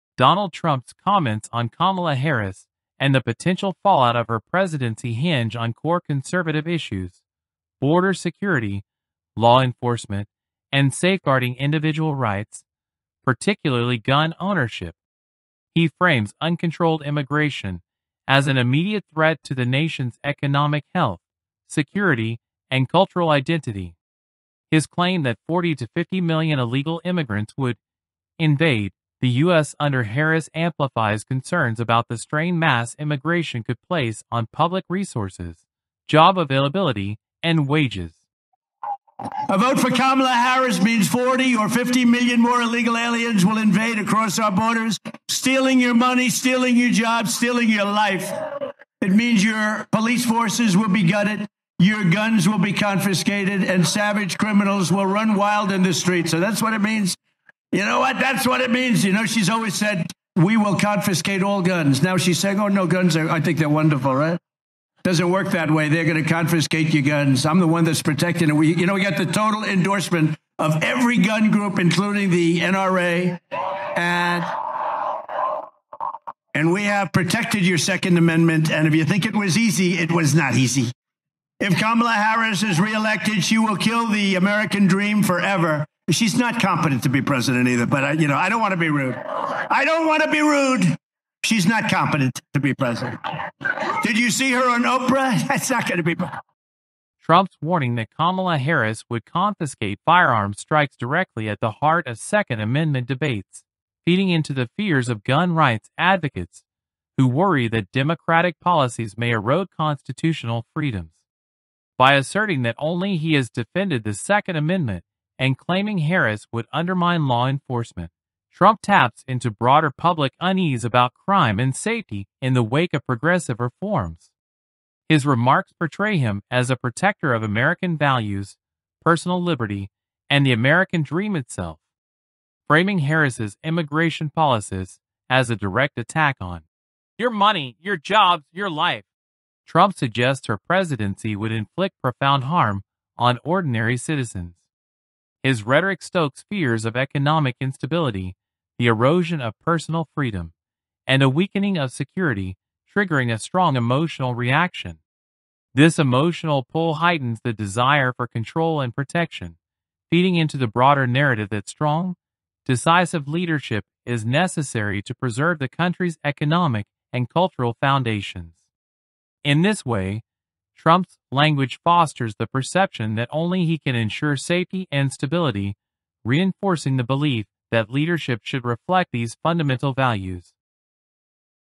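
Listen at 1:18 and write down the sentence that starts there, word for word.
And if you think it was easy, it was not easy.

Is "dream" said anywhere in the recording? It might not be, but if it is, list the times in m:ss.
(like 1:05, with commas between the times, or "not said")
1:24, 2:11.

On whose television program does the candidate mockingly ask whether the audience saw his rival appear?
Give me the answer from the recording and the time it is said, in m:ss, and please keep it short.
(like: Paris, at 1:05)
Oprah, at 1:34.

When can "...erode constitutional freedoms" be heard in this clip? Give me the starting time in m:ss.
1:49.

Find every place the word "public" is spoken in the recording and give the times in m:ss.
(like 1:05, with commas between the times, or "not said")
0:34, 1:59.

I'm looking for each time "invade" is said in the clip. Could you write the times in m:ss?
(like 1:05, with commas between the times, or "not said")
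0:28, 0:43.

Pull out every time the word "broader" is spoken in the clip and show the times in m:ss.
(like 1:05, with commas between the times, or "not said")
1:59, 2:40.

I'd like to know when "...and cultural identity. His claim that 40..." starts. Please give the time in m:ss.
0:22.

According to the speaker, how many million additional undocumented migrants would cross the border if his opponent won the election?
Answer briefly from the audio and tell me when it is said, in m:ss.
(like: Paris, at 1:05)
40 or 50 million, at 0:41.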